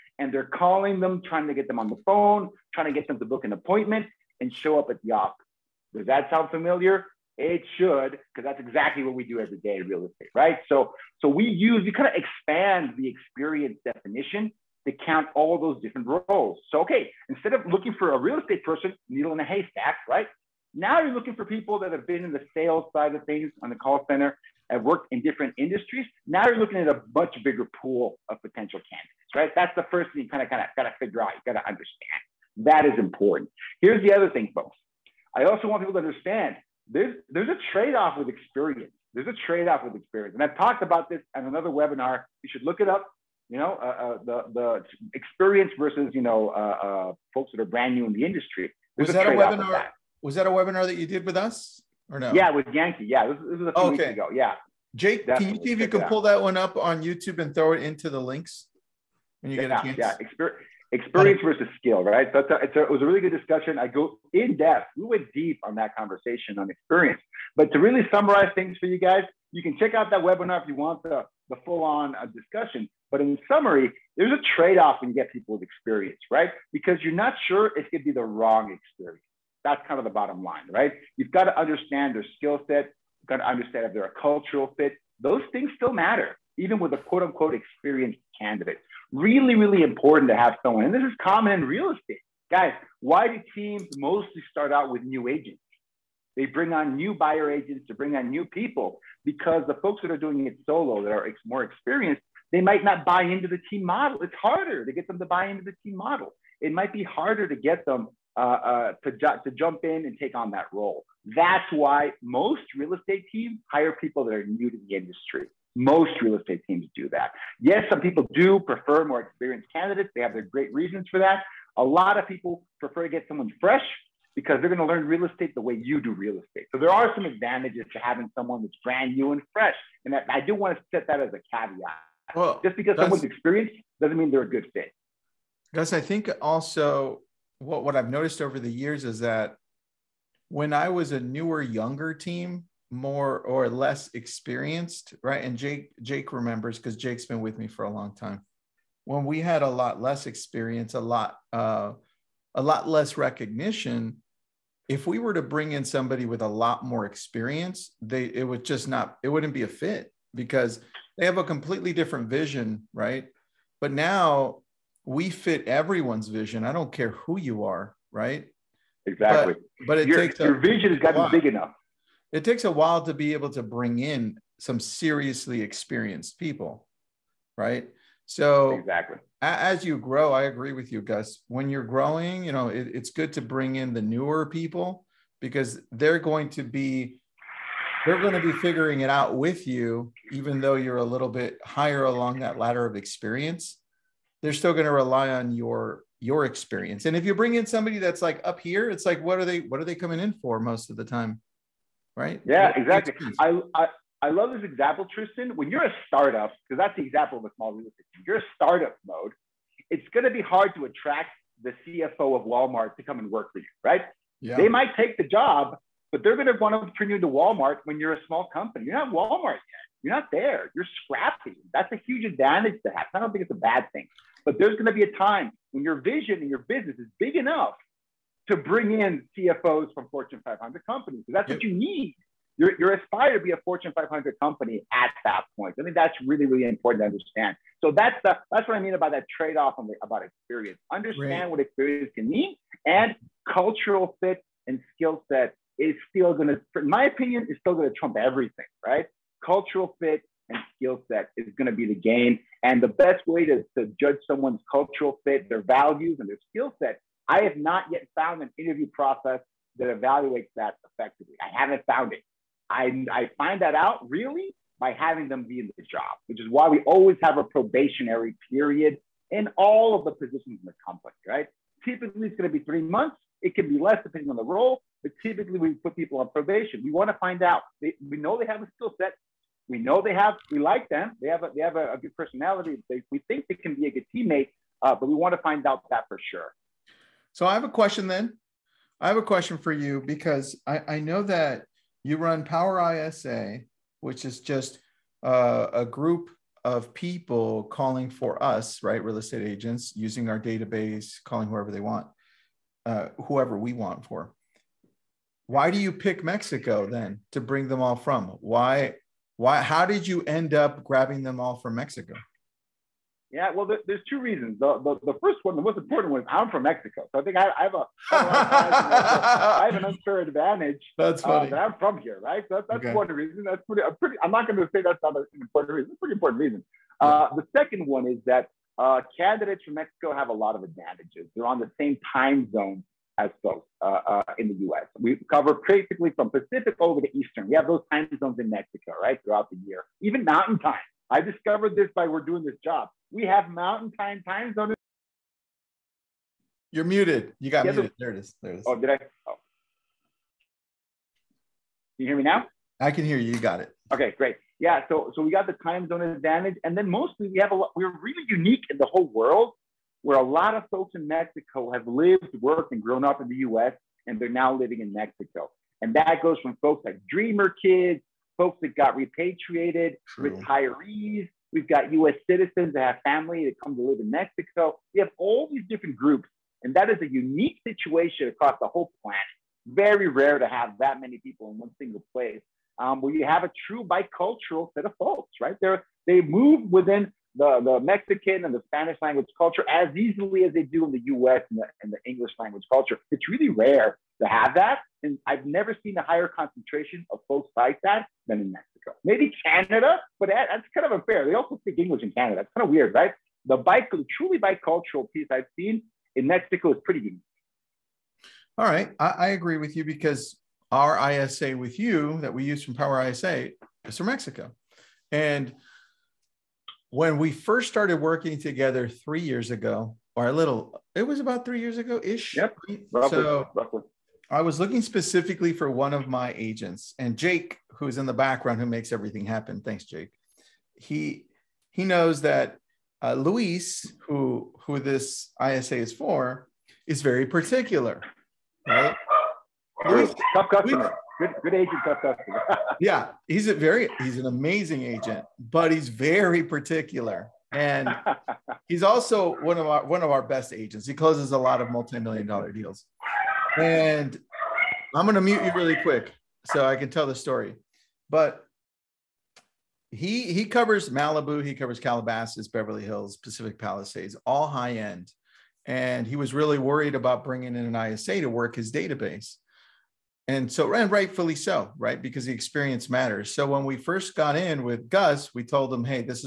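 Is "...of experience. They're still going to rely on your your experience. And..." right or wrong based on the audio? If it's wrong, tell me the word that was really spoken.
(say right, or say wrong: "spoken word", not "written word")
right.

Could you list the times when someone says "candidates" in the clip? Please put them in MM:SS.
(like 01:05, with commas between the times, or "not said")
00:28, 01:28, 01:59, 05:29.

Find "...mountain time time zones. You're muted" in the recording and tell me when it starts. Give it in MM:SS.
05:43.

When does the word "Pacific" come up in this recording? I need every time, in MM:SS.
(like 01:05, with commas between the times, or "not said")
05:36, 07:43.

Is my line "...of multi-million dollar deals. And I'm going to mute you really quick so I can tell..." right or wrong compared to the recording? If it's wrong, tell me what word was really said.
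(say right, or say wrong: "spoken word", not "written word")
right.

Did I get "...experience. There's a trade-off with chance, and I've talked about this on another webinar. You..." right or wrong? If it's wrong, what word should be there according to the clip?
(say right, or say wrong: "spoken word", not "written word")
wrong: "experience", not "chance".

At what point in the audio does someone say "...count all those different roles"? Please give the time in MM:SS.
00:15.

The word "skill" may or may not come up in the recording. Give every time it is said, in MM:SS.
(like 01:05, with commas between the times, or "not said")
01:01, 01:22, 04:04, 04:10, 04:16, 04:38.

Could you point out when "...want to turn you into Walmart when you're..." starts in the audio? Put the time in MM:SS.
03:36.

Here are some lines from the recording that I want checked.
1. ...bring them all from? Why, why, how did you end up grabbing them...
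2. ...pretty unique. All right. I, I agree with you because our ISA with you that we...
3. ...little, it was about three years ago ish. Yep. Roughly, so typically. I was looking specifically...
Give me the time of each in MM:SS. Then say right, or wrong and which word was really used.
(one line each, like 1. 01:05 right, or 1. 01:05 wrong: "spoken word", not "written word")
1. 05:07 right
2. 06:46 right
3. 07:00 wrong: "roughly", not "typically".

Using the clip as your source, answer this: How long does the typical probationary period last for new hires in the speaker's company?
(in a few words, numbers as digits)
3 months.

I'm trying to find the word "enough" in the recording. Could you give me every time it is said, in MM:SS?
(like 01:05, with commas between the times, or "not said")
02:51, 03:47.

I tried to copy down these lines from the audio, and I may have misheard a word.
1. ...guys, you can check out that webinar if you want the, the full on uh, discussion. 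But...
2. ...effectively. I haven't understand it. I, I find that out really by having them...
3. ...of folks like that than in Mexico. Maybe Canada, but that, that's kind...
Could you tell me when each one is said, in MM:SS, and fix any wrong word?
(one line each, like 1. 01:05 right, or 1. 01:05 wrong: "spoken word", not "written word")
1. 01:08 right
2. 04:20 wrong: "found", not "understand"
3. 06:37 right.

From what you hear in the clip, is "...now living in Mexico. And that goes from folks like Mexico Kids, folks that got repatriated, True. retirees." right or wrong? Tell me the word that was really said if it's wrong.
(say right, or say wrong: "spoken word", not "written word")
wrong: "Dreamer", not "Mexico".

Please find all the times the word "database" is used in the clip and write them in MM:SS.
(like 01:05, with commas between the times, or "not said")
05:00, 07:48.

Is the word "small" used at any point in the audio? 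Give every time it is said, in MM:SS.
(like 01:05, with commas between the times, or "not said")
03:27, 03:38.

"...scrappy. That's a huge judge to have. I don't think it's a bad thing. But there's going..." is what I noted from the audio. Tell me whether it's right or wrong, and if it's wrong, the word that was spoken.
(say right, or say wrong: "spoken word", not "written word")
wrong: "advantage", not "judge".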